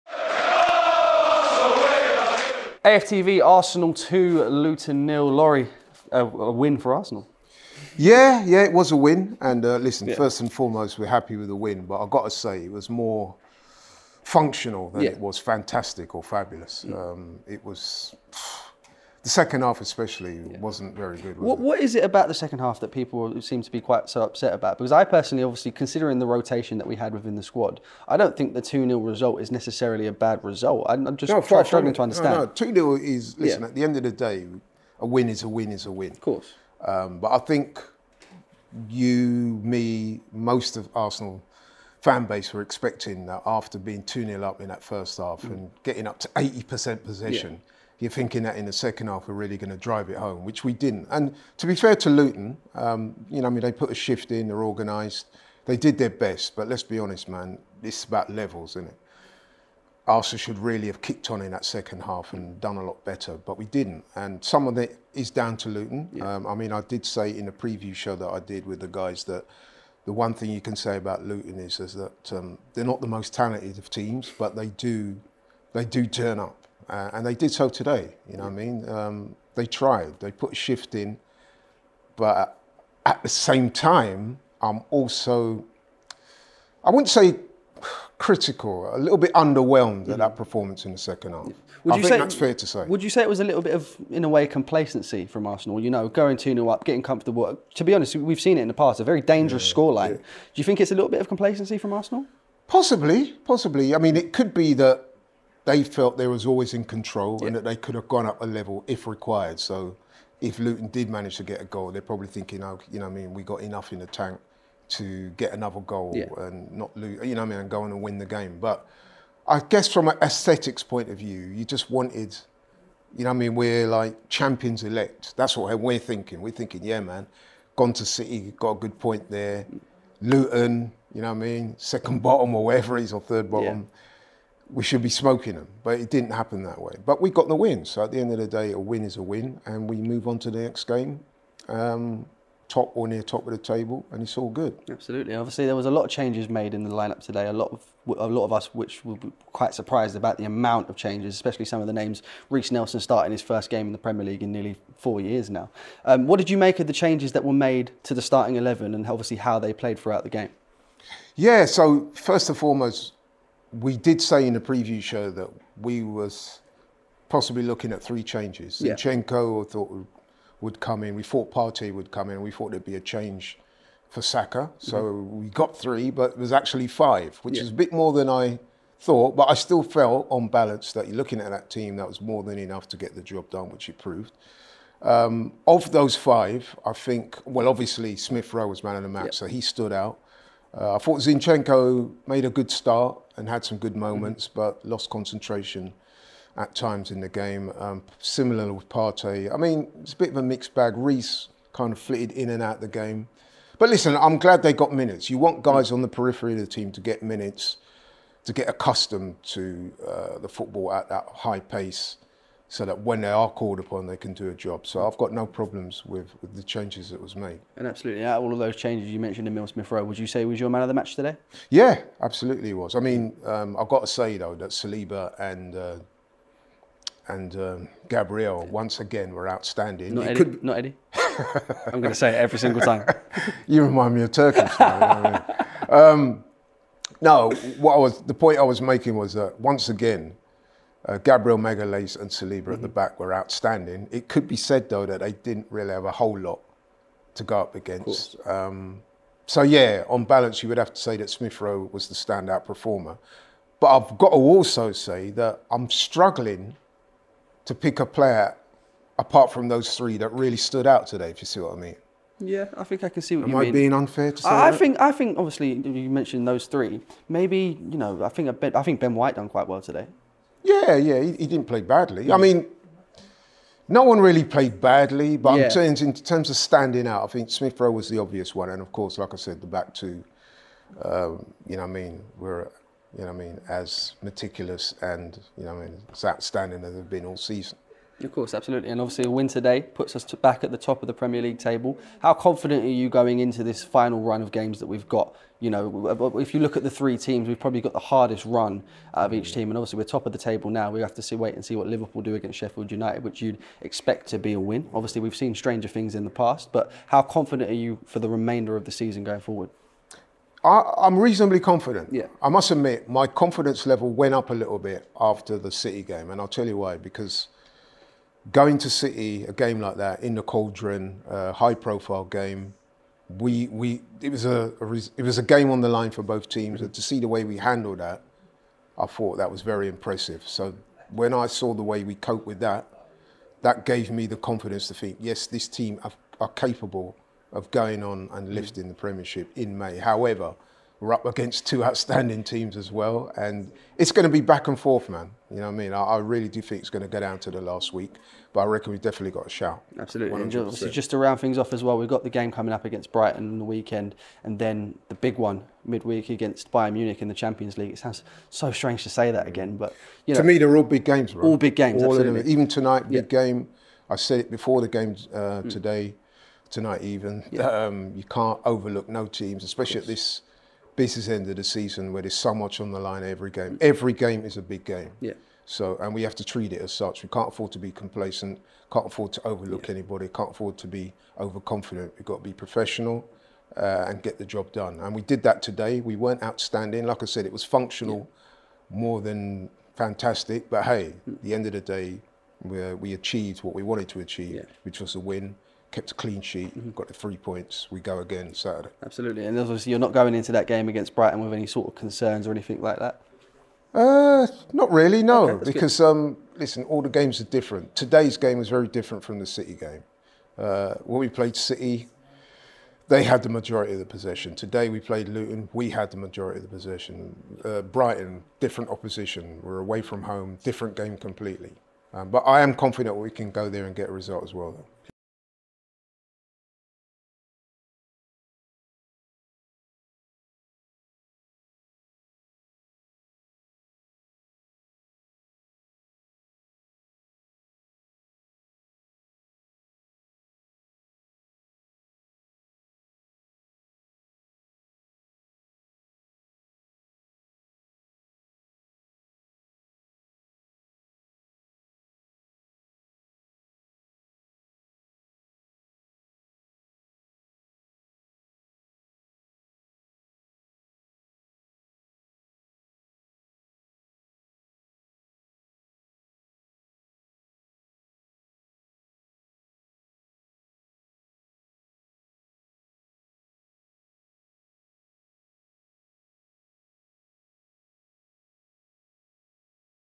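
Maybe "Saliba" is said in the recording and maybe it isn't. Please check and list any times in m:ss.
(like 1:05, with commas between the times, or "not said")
3:44, 4:02.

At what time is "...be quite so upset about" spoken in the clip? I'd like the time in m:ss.
0:23.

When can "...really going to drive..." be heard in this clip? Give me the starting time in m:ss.
0:49.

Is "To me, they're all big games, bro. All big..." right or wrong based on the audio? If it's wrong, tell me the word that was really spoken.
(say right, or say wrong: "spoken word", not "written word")
right.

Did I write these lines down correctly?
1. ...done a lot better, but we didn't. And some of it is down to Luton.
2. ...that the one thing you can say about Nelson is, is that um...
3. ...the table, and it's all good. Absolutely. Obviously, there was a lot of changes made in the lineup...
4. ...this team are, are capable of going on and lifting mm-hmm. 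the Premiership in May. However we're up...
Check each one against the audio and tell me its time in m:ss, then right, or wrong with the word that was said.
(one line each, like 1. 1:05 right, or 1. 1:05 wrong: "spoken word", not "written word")
1. 1:02 right
2. 1:09 wrong: "Luton", not "Nelson"
3. 2:23 right
4. 5:35 right.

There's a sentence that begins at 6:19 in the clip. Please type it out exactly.
anybody, can't afford to be overconfident.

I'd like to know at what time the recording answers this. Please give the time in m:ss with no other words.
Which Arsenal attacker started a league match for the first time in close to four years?
2:32.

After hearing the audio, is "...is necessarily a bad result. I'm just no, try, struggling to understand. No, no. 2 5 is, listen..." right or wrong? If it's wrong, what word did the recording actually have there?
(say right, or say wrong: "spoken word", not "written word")
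wrong: "0", not "5".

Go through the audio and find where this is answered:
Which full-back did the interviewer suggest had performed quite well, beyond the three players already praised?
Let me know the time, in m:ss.
4:28.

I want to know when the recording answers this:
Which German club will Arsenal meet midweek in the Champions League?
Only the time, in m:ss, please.
5:56.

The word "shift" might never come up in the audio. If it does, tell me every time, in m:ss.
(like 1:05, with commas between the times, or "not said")
0:53, 1:20.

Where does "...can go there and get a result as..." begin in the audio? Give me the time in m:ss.
7:03.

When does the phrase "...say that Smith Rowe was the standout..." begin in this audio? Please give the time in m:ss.
4:11.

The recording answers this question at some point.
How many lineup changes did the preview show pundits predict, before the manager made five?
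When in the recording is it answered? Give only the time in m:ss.
2:48.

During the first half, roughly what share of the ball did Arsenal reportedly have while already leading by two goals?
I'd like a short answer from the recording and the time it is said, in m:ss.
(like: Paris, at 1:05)
80%, at 0:46.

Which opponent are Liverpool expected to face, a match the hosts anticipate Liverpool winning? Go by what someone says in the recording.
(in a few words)
Sheffield United.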